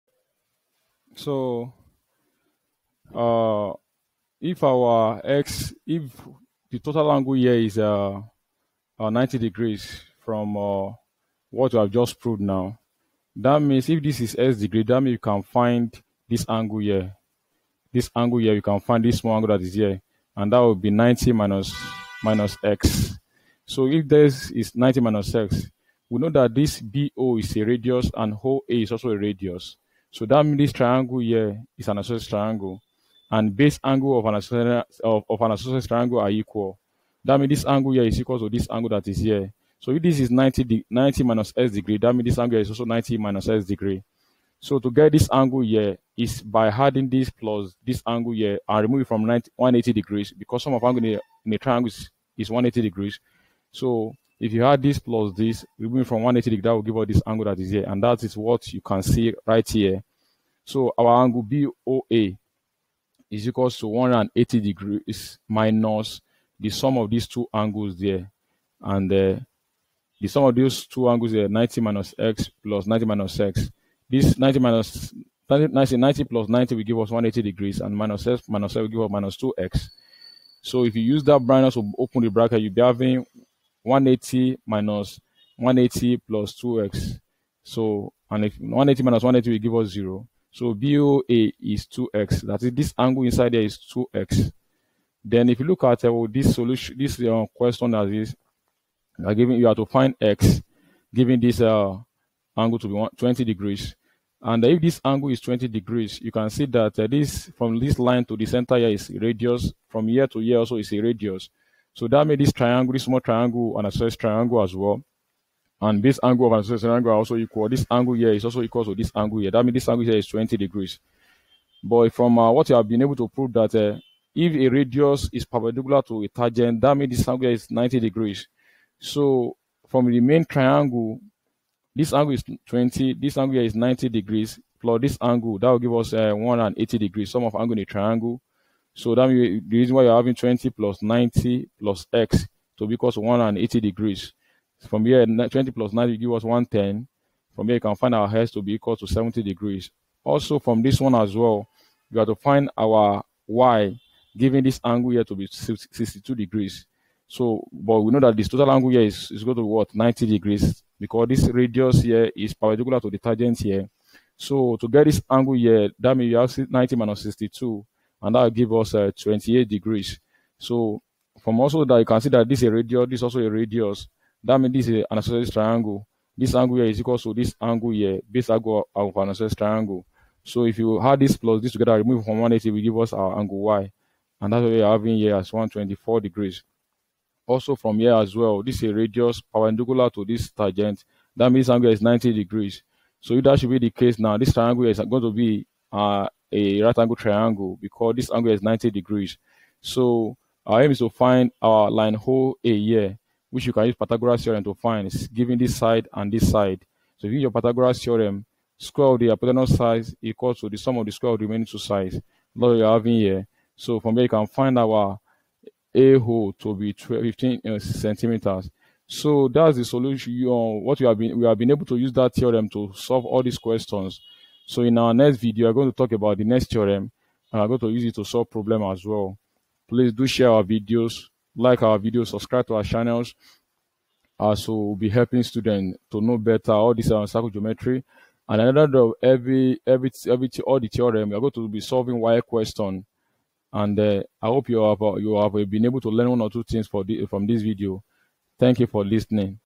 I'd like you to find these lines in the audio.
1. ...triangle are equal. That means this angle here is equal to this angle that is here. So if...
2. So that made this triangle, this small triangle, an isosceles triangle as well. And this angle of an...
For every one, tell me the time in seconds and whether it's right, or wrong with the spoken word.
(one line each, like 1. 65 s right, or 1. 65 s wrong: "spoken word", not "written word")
1. 35 s right
2. 111 s right.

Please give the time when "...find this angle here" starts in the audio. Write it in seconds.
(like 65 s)
15 s.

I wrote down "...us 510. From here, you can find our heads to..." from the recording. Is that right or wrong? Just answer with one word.
wrong.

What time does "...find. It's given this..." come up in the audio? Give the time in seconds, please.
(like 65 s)
204 s.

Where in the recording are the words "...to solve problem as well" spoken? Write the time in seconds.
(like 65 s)
228 s.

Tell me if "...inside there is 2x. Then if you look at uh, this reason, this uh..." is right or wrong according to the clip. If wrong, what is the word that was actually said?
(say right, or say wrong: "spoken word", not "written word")
wrong: "solution", not "reason".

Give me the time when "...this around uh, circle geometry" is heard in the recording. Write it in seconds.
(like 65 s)
236 s.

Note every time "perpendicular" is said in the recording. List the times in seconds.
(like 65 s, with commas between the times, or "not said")
125 s, 162 s, 189 s.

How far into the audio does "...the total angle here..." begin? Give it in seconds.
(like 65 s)
6 s.